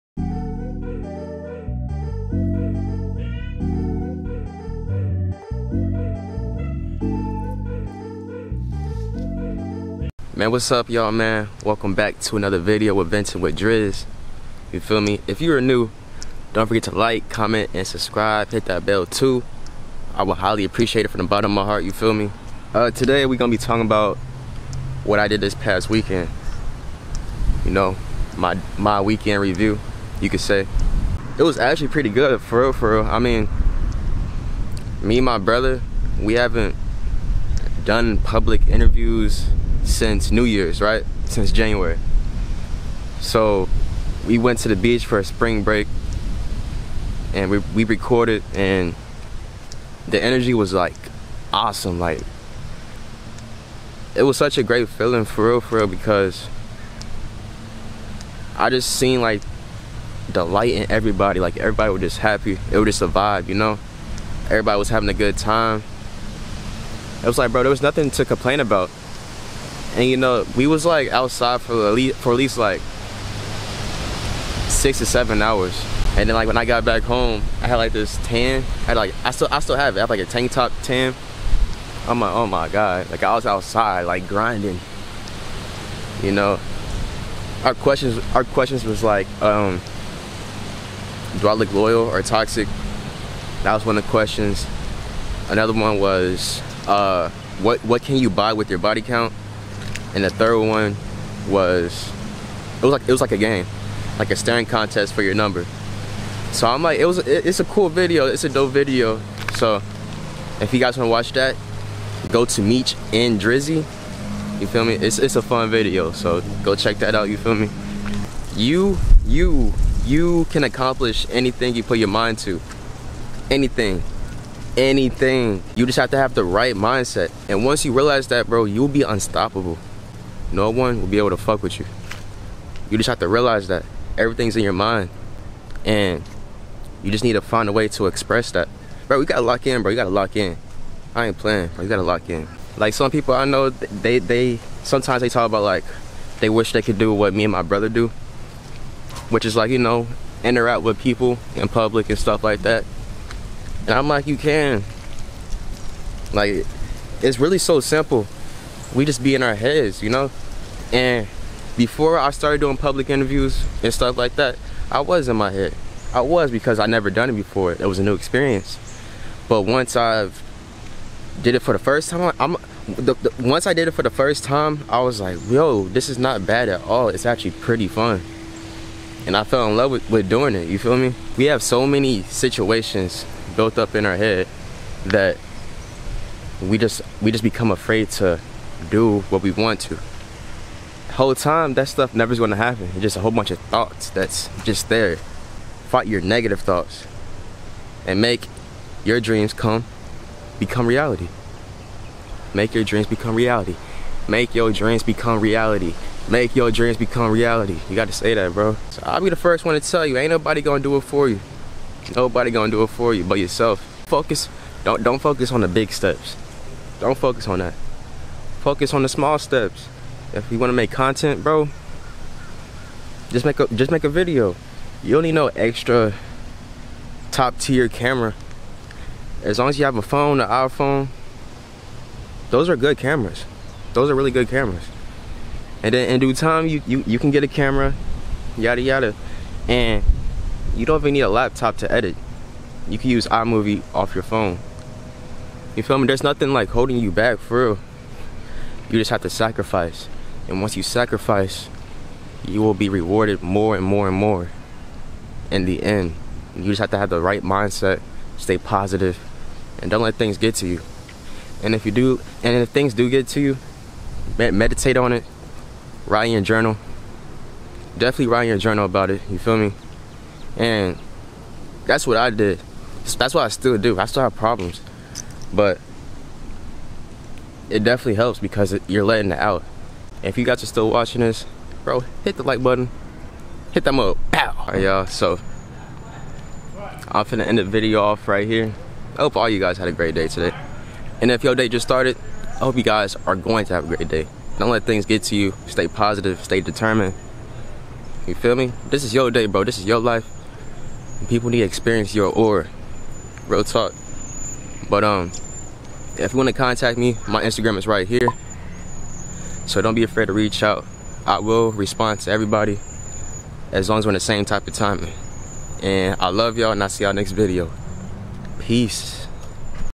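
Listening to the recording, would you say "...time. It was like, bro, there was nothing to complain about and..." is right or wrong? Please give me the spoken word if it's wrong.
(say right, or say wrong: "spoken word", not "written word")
right.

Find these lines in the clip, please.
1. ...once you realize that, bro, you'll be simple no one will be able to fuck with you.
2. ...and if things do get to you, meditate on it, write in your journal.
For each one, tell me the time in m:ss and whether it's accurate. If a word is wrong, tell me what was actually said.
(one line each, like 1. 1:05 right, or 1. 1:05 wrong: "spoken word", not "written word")
1. 2:07 wrong: "unstoppable", not "simple"
2. 4:22 right.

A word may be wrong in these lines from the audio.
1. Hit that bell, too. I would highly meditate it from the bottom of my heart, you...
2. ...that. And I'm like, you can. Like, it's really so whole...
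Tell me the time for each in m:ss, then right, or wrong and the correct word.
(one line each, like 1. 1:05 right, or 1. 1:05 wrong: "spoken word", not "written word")
1. 0:18 wrong: "appreciate", not "meditate"
2. 2:32 wrong: "simple", not "whole".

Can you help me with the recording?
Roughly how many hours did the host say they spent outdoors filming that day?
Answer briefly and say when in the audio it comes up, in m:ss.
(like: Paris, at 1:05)
6 to 7, at 1:14.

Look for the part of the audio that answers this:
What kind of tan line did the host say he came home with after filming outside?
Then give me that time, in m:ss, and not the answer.
1:20.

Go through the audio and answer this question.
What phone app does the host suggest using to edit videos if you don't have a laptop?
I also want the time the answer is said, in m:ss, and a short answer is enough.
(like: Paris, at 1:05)
iMovie, at 4:03.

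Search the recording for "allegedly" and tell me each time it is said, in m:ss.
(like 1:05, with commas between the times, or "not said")
not said.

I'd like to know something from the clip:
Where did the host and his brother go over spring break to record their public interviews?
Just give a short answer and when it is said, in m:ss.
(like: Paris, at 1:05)
the beach, at 0:44.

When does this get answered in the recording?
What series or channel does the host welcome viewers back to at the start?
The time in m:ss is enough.
0:13.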